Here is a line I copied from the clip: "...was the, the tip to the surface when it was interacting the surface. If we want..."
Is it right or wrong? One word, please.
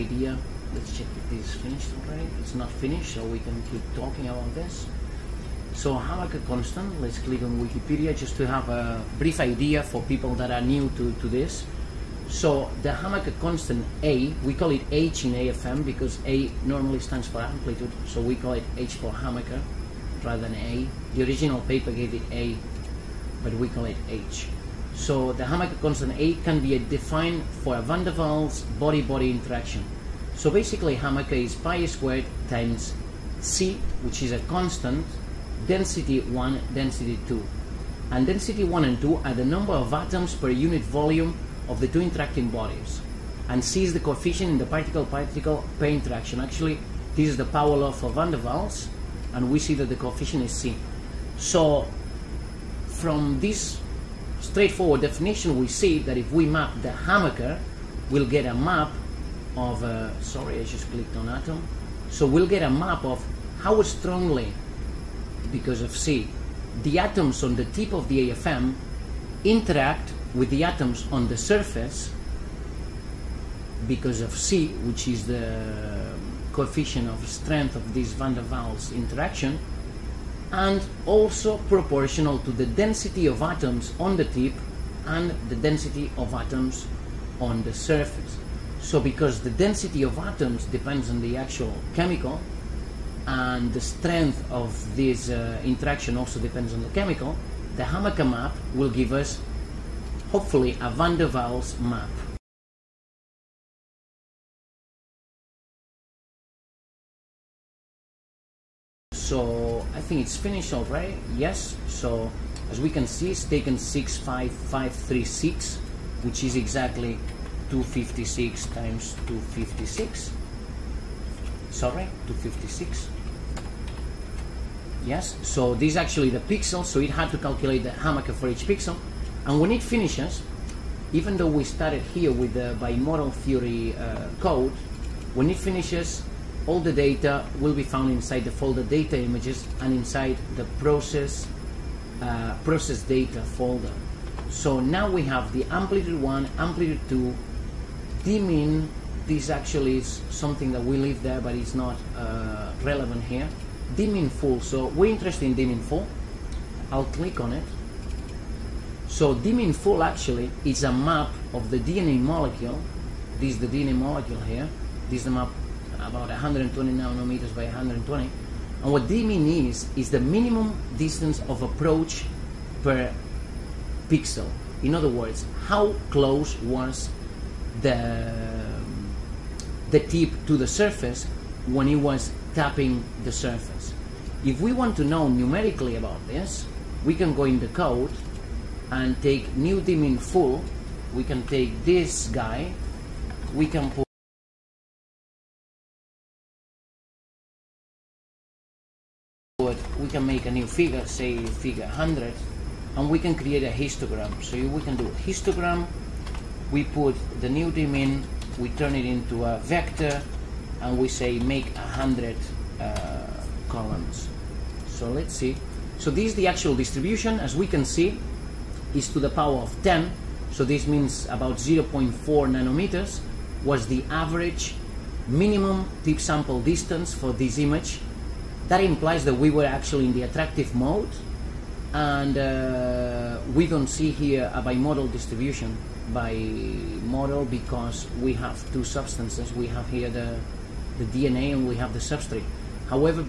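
wrong.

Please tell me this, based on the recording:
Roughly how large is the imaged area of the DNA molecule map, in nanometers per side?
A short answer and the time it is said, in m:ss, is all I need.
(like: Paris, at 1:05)
120 nanometers, at 2:46.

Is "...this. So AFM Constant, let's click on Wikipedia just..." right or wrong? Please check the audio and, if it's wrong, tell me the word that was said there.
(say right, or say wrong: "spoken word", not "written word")
wrong: "Hamaker", not "AFM".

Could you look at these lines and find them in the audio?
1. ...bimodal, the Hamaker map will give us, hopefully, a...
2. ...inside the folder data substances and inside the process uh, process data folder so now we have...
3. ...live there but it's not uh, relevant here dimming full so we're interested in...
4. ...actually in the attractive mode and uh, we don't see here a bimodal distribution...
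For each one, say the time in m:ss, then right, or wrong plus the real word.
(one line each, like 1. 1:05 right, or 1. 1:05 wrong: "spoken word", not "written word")
1. 1:36 wrong: "chemical", not "bimodal"
2. 2:18 wrong: "images", not "substances"
3. 2:30 right
4. 3:49 right.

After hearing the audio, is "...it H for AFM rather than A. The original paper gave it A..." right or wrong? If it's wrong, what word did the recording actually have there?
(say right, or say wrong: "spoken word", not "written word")
wrong: "Hamaker", not "AFM".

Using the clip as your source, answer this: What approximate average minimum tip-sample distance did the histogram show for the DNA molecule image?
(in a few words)
0.4 nanometers.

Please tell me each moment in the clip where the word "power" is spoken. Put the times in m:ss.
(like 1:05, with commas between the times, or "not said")
0:47, 3:39.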